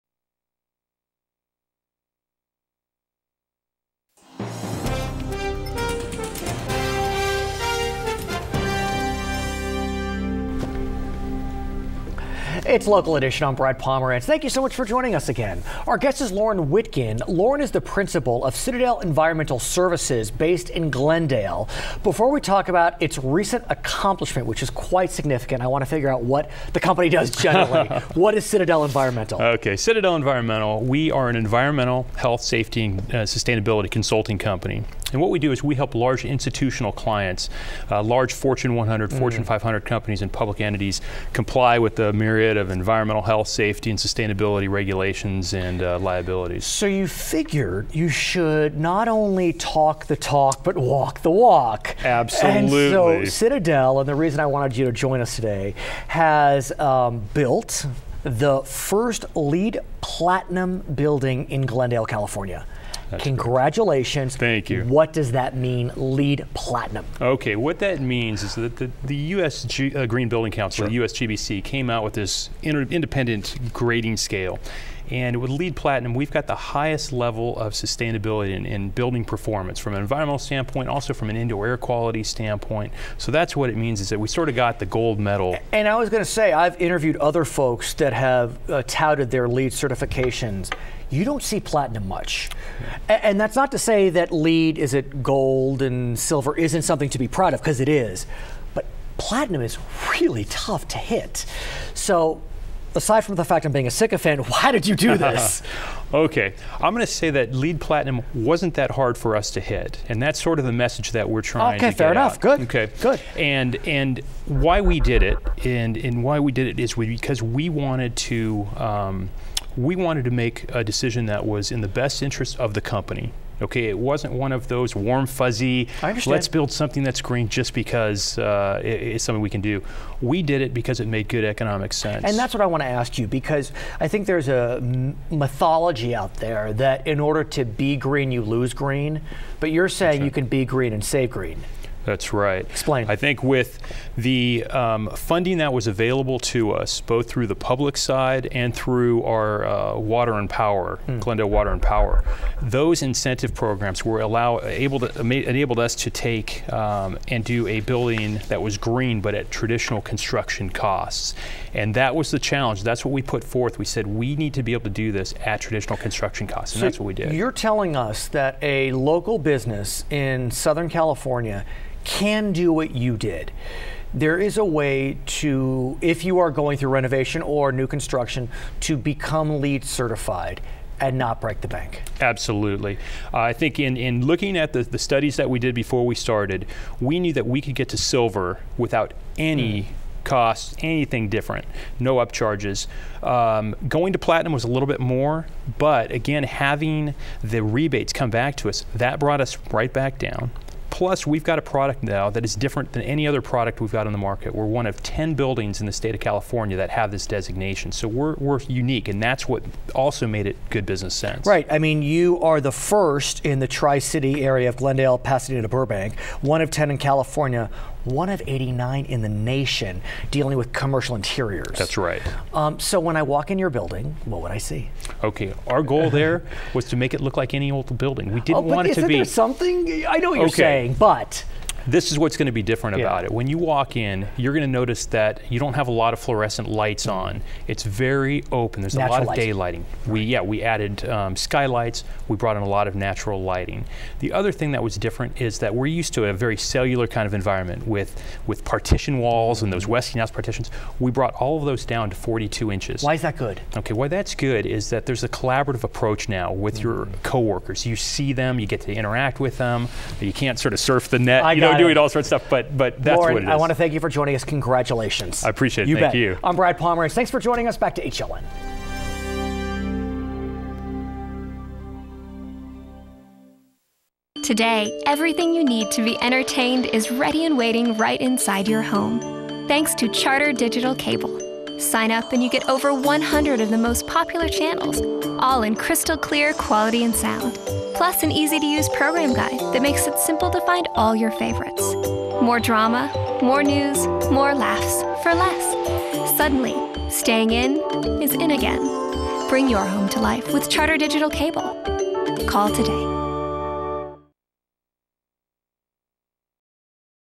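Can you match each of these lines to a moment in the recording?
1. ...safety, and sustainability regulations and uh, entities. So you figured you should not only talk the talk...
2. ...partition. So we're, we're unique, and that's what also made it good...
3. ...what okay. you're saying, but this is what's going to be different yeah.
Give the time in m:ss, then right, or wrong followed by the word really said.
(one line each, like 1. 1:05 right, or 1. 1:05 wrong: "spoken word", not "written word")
1. 0:43 wrong: "liabilities", not "entities"
2. 3:27 wrong: "designation", not "partition"
3. 3:50 right.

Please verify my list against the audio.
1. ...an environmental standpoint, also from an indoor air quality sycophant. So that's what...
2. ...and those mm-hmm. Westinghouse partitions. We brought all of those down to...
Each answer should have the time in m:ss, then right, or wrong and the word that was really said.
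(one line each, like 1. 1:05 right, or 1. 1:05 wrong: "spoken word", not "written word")
1. 1:19 wrong: "standpoint", not "sycophant"
2. 4:09 right.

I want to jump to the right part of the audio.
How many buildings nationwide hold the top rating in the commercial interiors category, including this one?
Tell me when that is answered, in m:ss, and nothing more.
3:38.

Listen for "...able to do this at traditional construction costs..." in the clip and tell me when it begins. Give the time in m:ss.
2:44.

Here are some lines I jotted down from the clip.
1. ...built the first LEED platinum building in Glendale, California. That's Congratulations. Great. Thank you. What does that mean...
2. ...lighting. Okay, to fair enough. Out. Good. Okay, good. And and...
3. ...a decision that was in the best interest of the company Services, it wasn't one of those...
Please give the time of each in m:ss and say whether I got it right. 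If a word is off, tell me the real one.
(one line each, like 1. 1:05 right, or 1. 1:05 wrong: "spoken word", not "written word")
1. 0:57 right
2. 1:51 wrong: "trying", not "lighting"
3. 2:00 wrong: "Okay", not "Services".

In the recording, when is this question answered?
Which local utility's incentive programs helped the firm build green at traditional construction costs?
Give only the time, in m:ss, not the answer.
2:31.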